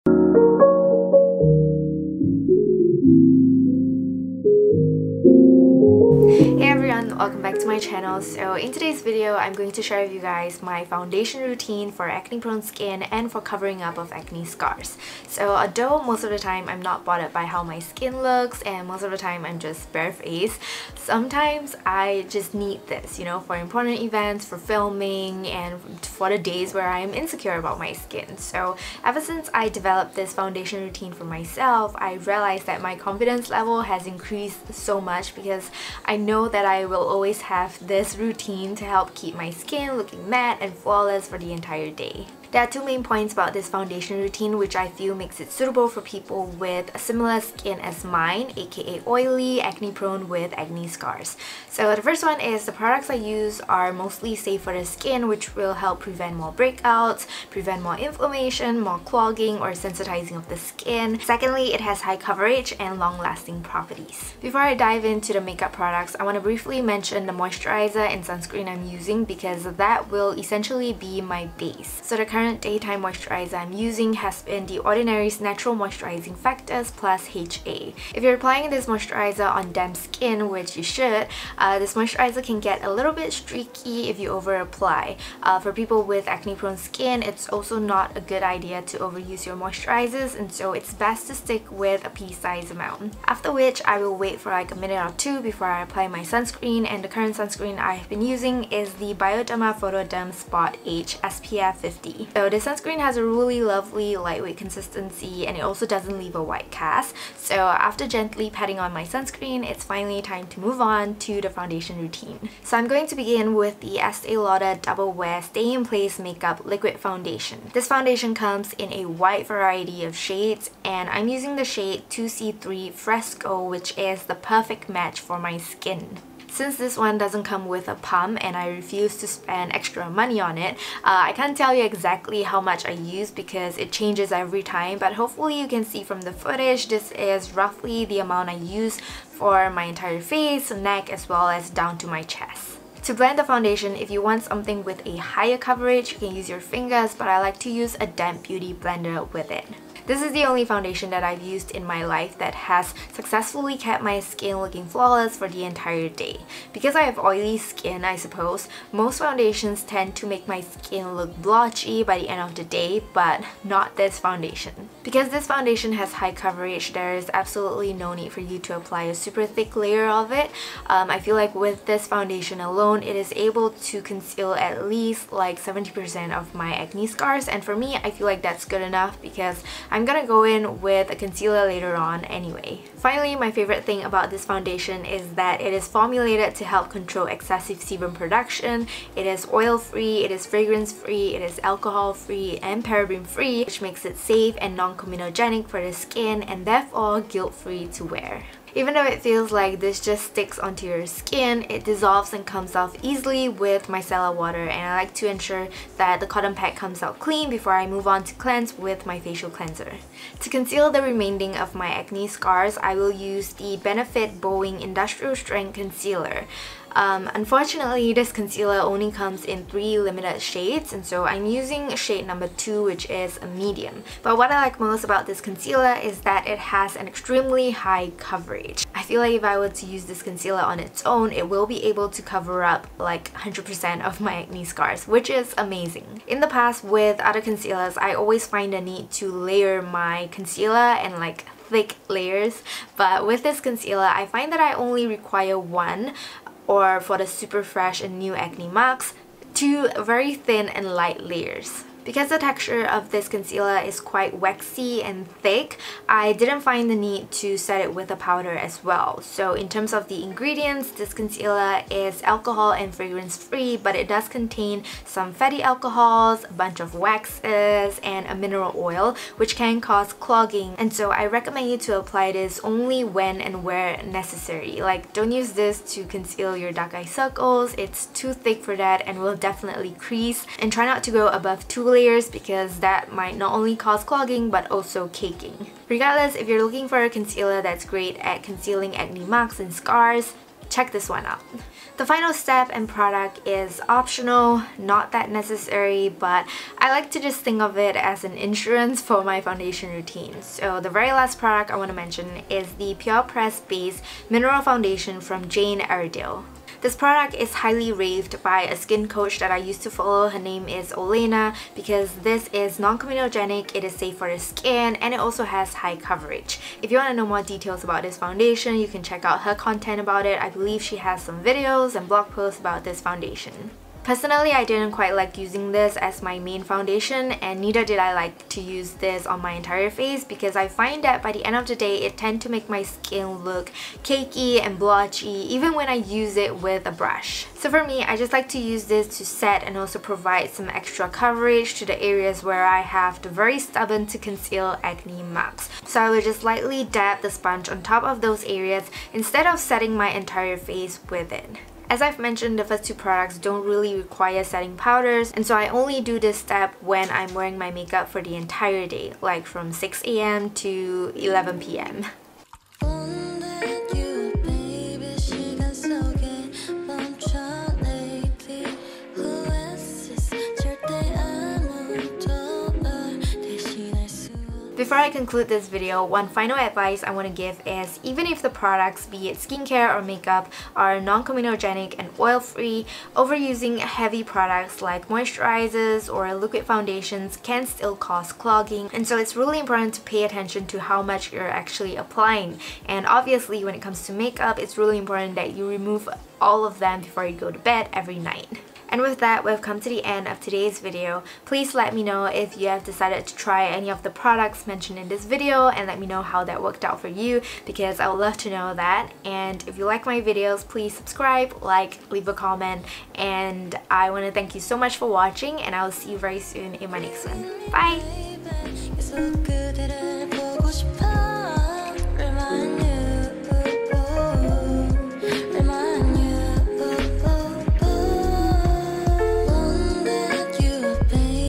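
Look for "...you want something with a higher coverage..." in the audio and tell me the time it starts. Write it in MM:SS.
02:24.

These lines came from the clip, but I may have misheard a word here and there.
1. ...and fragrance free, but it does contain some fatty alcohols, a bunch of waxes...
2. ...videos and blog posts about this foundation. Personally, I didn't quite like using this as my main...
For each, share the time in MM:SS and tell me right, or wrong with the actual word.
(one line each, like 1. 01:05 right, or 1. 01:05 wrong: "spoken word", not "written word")
1. 04:22 right
2. 05:21 right.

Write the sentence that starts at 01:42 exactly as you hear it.
So this sunscreen has a really lovely lightweight consistency and it also doesn't leave a white cast.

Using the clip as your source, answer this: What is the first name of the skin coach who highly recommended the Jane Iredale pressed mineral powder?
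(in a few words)
Olena.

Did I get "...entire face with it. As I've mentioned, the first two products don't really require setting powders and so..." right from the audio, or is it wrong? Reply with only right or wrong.
right.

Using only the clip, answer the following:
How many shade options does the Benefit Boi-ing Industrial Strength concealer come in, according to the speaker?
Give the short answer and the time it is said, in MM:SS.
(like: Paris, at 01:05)
3, at 03:39.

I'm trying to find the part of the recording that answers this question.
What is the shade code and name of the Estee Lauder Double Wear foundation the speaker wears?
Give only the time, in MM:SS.
02:02.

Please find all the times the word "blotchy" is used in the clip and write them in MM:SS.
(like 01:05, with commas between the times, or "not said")
02:41, 05:34.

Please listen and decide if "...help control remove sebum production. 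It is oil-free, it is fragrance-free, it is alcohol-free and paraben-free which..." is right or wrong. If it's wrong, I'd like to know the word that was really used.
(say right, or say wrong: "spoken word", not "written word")
wrong: "excessive", not "remove".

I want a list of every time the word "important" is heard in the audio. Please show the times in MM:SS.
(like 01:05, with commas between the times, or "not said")
00:23, 06:29, 06:34.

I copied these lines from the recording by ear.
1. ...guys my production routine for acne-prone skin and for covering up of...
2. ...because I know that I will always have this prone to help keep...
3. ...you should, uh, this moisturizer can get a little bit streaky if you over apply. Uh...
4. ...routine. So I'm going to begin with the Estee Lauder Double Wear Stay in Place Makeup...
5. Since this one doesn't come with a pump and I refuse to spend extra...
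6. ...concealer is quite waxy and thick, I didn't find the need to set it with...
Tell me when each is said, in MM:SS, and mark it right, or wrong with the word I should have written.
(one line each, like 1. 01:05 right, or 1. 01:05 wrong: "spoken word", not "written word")
1. 00:10 wrong: "foundation", not "production"
2. 00:35 wrong: "routine", not "prone"
3. 01:20 right
4. 01:52 right
5. 02:06 right
6. 04:13 right.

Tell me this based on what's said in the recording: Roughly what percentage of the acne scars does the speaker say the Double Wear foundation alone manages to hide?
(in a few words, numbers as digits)
70%.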